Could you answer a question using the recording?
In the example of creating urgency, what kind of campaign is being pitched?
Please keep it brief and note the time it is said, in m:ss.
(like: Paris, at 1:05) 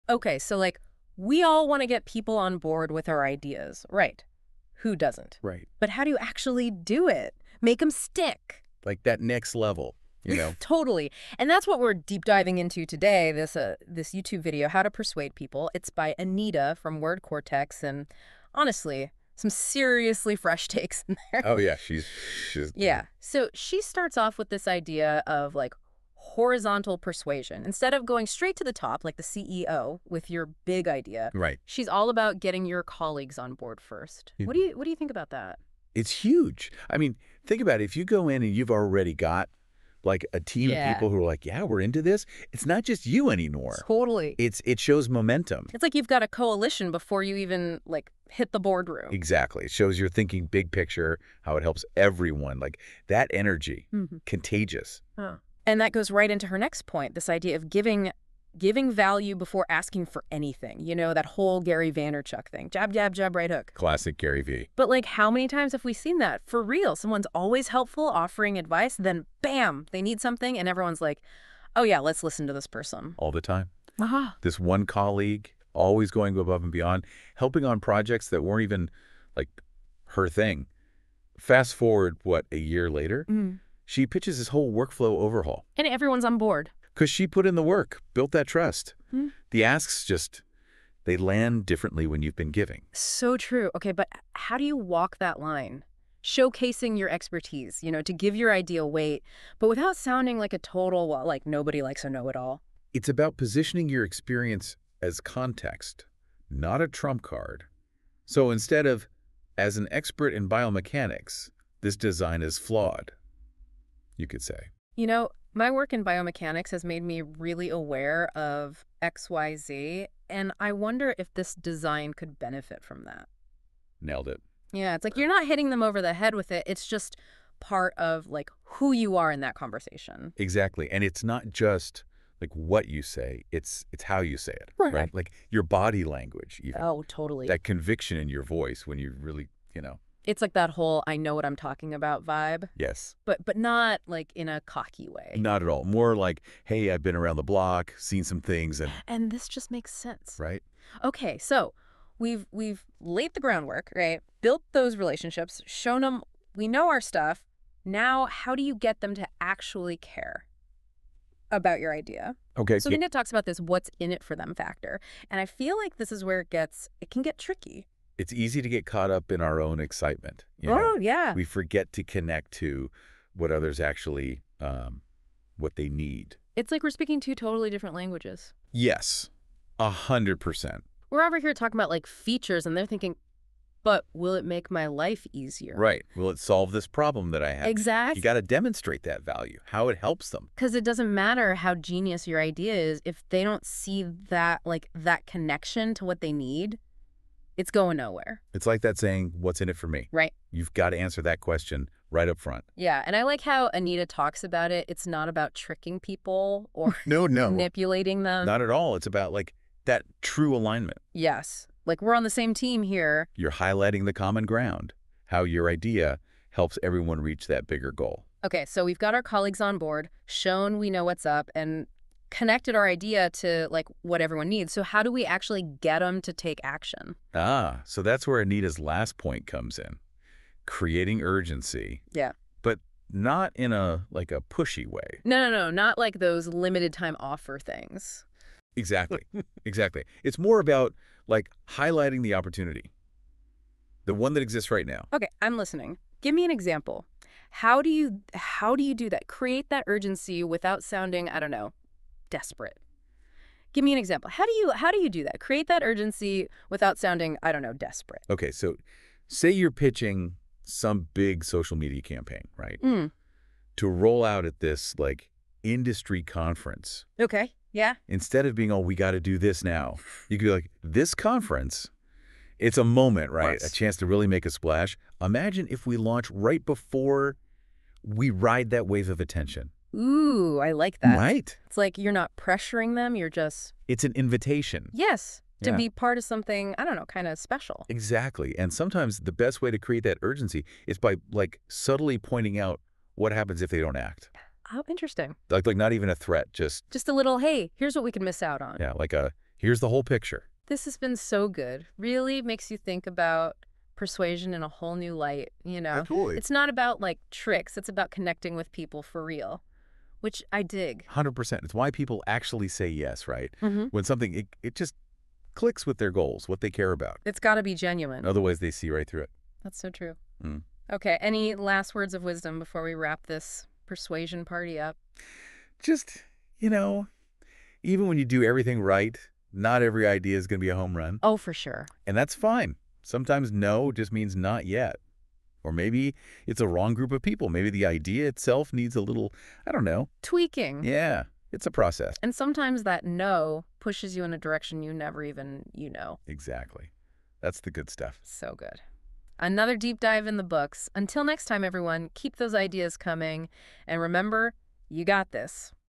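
Social media campaign, at 4:21.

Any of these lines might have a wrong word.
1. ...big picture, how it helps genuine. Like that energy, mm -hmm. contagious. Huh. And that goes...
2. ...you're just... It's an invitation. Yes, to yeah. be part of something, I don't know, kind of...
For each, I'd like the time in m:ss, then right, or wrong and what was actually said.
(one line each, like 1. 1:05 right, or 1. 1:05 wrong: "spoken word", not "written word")
1. 0:50 wrong: "everyone", not "genuine"
2. 4:43 right.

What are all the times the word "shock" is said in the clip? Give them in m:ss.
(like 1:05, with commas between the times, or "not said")
not said.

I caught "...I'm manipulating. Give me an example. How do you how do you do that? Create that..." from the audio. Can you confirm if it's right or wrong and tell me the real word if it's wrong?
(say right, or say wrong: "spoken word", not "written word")
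wrong: "listening", not "manipulating".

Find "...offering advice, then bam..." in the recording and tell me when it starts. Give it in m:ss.
1:08.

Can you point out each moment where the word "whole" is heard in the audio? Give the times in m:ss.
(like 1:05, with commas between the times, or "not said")
1:01, 1:24, 2:20, 4:59, 5:04.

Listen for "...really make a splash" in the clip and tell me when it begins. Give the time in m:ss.
4:34.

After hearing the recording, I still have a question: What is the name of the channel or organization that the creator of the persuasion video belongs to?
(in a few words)
Word Cortex.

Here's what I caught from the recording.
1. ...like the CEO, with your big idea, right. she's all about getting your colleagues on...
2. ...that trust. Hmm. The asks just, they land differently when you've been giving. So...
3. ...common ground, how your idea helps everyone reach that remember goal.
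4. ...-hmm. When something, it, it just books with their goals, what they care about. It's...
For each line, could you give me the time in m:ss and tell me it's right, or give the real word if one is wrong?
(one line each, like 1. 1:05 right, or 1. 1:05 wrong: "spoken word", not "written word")
1. 0:29 right
2. 1:28 right
3. 3:34 wrong: "bigger", not "remember"
4. 5:13 wrong: "clicks", not "books".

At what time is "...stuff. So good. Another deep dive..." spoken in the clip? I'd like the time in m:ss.
5:47.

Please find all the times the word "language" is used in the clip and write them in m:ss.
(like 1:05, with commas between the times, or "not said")
2:16, 2:57.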